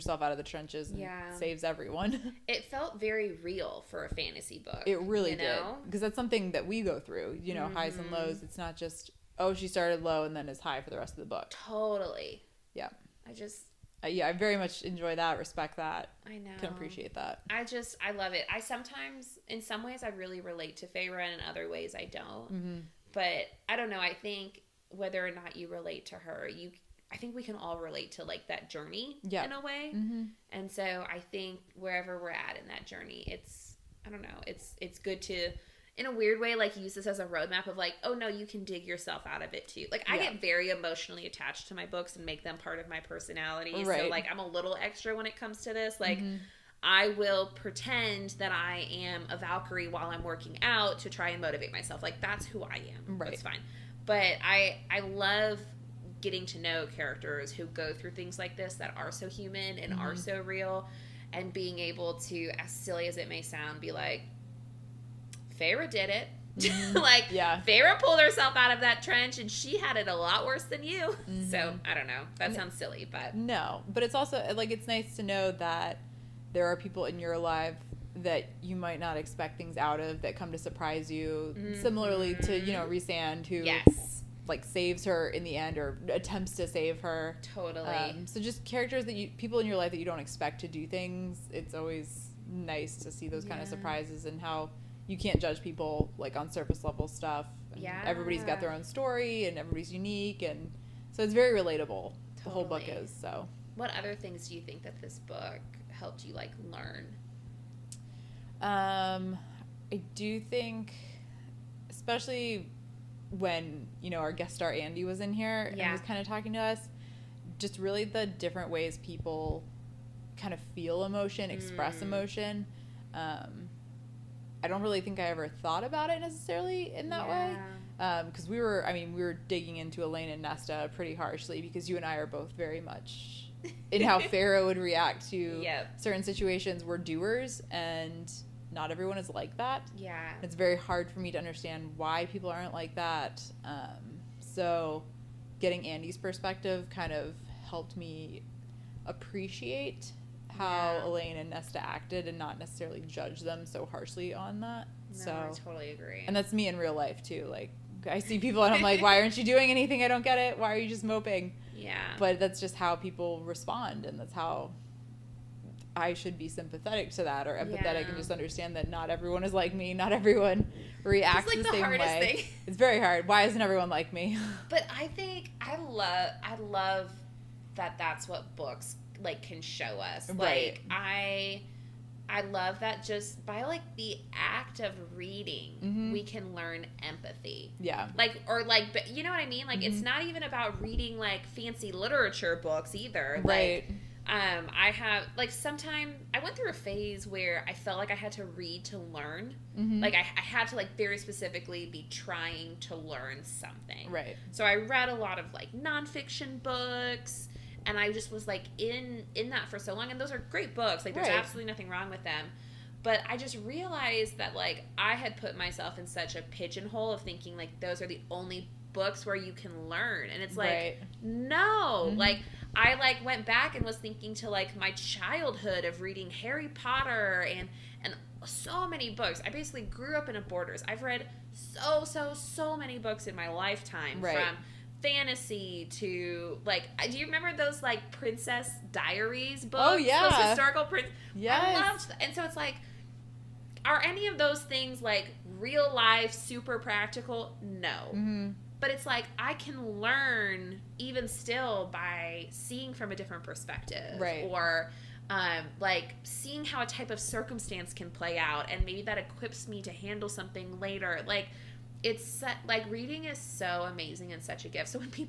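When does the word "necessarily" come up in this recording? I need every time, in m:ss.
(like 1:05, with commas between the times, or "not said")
2:06, 2:32.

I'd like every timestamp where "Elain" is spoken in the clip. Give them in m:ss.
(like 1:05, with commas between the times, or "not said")
2:10, 2:31.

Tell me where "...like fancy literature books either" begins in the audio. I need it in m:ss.
3:11.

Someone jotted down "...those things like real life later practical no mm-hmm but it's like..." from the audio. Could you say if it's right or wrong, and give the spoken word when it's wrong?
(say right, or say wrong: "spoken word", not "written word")
wrong: "super", not "later".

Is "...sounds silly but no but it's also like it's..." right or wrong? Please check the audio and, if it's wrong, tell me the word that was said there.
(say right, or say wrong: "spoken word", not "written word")
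right.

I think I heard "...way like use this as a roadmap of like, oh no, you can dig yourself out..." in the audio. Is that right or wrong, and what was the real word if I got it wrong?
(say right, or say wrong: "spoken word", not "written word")
right.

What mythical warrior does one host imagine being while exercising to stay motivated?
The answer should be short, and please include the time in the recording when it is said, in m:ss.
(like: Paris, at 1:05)
Valkyrie, at 0:49.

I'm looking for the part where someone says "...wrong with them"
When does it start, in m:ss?
3:31.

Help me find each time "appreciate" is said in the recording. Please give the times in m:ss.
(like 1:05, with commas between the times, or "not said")
0:16, 2:29.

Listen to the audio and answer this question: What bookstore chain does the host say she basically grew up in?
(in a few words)
Borders.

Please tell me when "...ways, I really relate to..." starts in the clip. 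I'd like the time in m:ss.
0:19.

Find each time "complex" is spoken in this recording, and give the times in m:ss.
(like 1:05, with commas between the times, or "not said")
not said.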